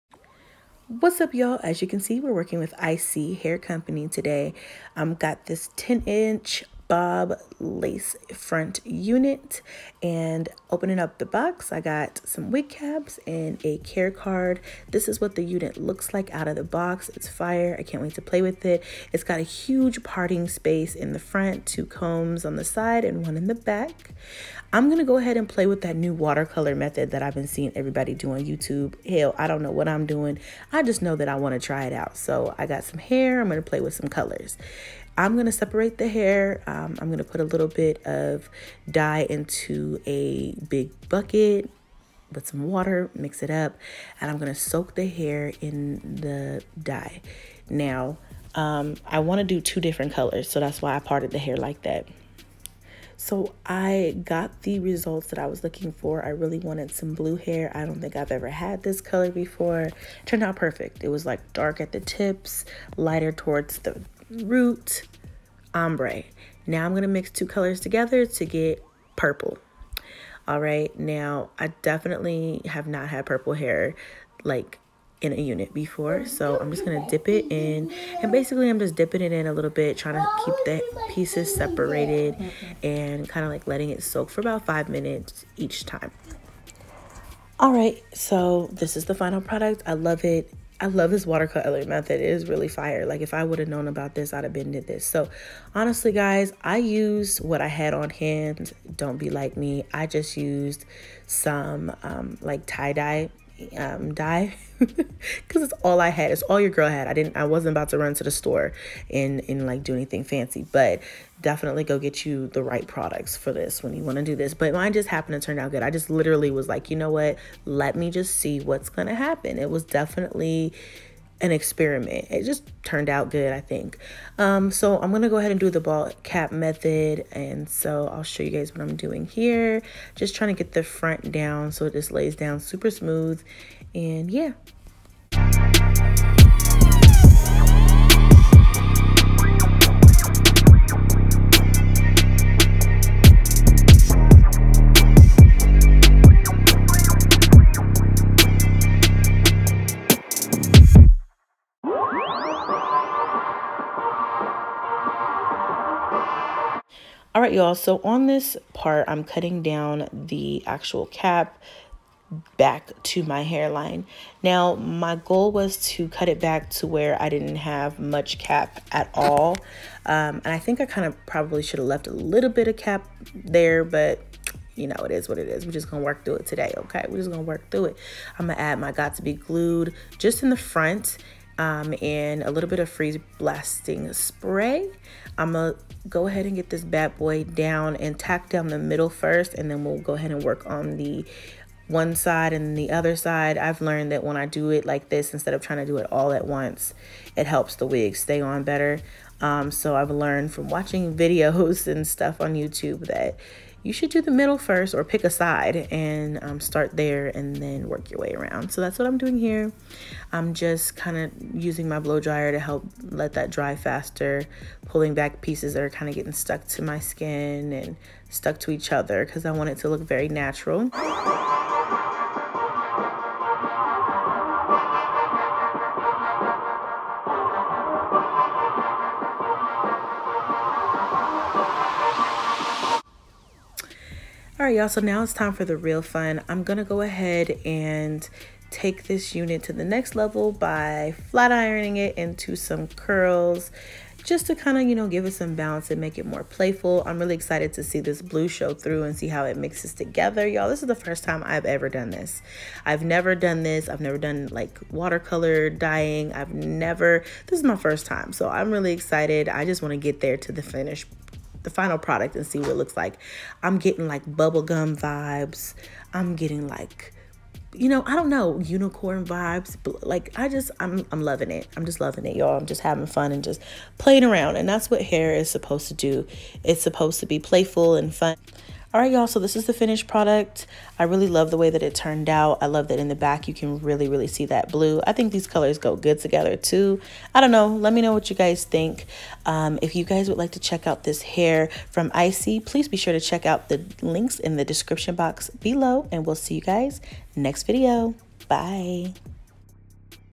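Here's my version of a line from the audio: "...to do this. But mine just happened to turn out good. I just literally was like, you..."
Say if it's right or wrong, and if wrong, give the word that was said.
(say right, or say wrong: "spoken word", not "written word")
right.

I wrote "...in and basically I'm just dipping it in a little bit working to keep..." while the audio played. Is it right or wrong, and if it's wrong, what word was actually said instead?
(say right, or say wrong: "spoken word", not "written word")
wrong: "trying", not "working".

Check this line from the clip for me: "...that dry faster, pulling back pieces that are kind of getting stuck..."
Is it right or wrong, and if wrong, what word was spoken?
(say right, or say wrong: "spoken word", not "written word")
right.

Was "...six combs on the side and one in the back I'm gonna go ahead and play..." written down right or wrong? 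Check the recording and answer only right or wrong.
wrong.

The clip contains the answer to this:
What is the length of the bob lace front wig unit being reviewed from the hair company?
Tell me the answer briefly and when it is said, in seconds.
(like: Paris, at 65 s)
10 inch, at 5 s.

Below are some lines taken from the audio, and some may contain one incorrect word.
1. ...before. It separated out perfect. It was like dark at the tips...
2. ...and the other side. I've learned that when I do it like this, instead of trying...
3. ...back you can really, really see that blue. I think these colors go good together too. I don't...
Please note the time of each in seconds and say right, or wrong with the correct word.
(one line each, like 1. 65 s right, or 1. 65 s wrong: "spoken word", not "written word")
1. 59 s wrong: "turned", not "separated"
2. 192 s right
3. 283 s right.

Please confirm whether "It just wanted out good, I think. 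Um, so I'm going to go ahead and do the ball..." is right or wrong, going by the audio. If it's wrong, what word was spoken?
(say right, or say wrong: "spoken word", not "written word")
wrong: "turned", not "wanted".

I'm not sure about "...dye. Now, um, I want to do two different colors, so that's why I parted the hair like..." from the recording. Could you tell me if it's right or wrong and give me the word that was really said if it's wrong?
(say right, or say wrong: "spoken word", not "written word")
right.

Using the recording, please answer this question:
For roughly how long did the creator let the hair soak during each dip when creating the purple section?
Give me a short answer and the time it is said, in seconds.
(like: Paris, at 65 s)
about five minutes, at 84 s.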